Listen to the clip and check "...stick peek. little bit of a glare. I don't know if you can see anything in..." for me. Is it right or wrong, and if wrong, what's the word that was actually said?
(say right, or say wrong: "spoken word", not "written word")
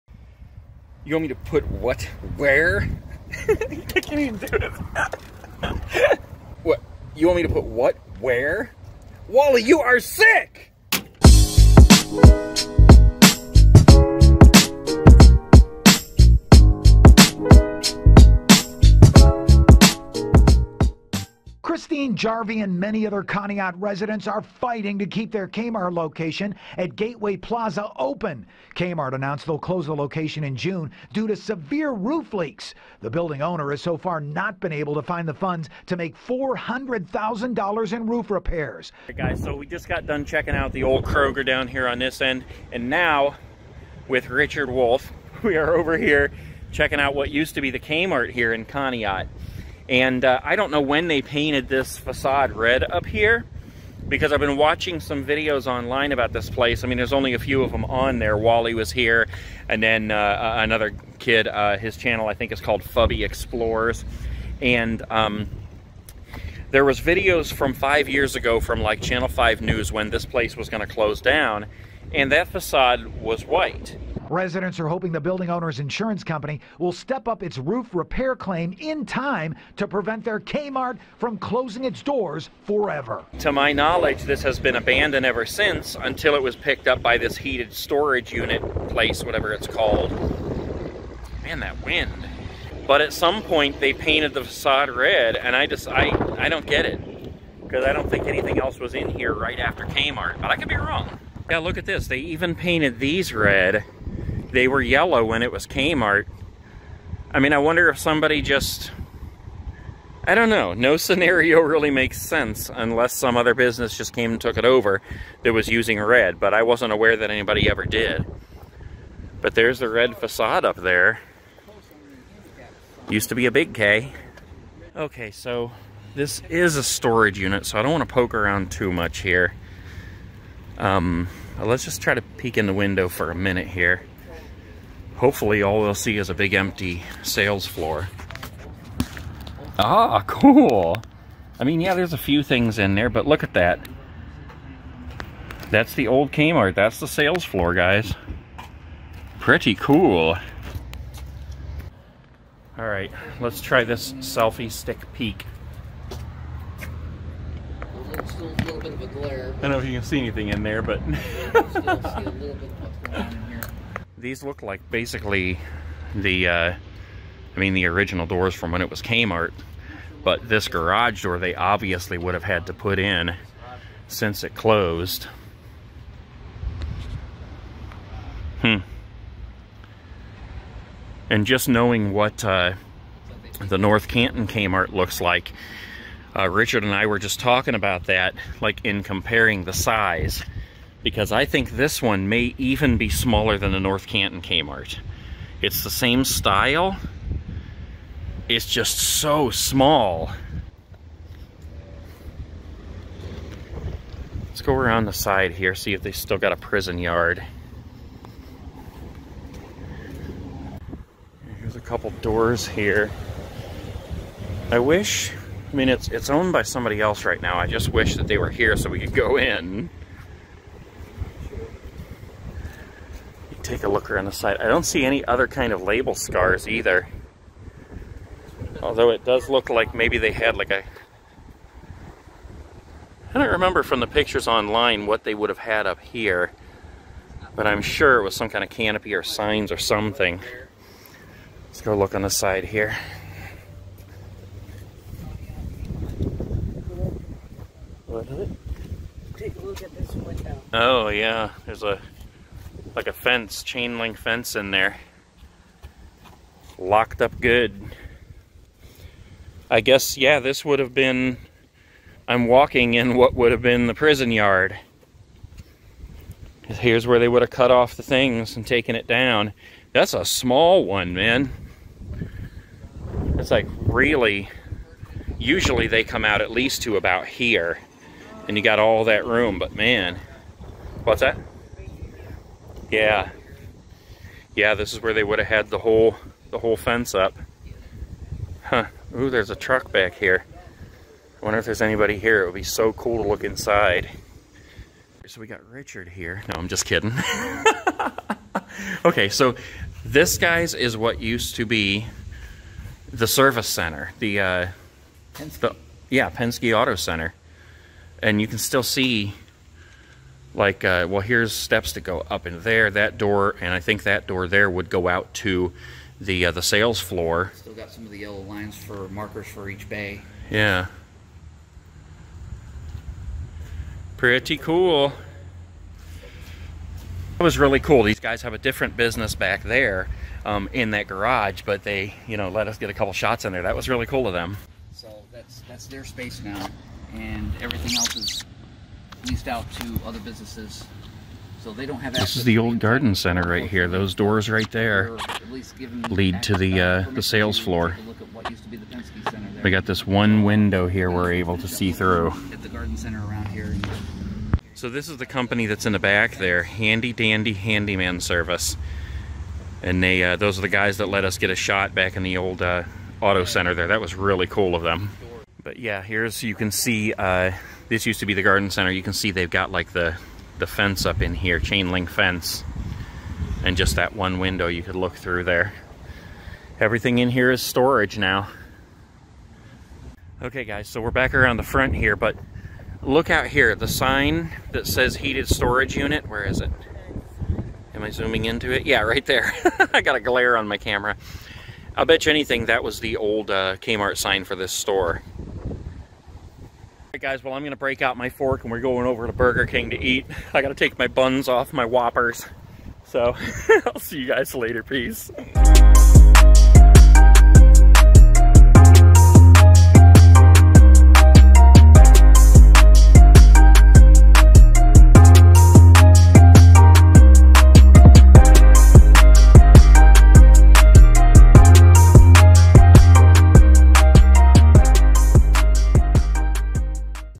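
right.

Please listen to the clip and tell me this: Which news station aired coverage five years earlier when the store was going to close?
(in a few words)
Channel 5 News.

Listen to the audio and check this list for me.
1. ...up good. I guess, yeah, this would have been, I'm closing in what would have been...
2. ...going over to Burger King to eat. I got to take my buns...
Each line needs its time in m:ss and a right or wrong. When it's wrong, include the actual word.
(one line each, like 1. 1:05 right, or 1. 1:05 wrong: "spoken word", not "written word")
1. 4:17 wrong: "walking", not "closing"
2. 6:38 right.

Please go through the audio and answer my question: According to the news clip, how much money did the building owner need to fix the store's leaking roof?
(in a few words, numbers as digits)
$400,000.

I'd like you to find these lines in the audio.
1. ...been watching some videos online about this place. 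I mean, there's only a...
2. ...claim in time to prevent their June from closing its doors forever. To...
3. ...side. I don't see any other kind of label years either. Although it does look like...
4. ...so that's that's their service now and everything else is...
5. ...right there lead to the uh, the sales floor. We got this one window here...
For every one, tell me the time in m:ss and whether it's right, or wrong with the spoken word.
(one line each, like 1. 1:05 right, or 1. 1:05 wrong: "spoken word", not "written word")
1. 0:54 right
2. 1:18 wrong: "Kmart", not "June"
3. 3:44 wrong: "scars", not "years"
4. 5:34 wrong: "space", not "service"
5. 5:44 right.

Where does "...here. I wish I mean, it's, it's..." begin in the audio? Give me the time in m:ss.
3:32.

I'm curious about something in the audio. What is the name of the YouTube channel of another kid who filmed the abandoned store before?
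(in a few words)
Fubby Explorers.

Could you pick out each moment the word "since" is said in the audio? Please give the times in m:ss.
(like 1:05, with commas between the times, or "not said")
1:25, 2:54.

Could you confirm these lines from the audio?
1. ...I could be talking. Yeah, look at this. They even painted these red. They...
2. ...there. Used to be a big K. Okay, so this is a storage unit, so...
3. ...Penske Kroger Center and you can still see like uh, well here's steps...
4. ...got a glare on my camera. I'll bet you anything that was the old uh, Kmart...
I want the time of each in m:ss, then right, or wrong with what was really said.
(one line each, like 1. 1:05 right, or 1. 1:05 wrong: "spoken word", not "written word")
1. 1:40 wrong: "wrong", not "talking"
2. 2:00 right
3. 5:06 wrong: "Auto", not "Kroger"
4. 6:30 right.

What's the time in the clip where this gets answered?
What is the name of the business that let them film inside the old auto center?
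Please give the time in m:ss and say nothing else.
5:56.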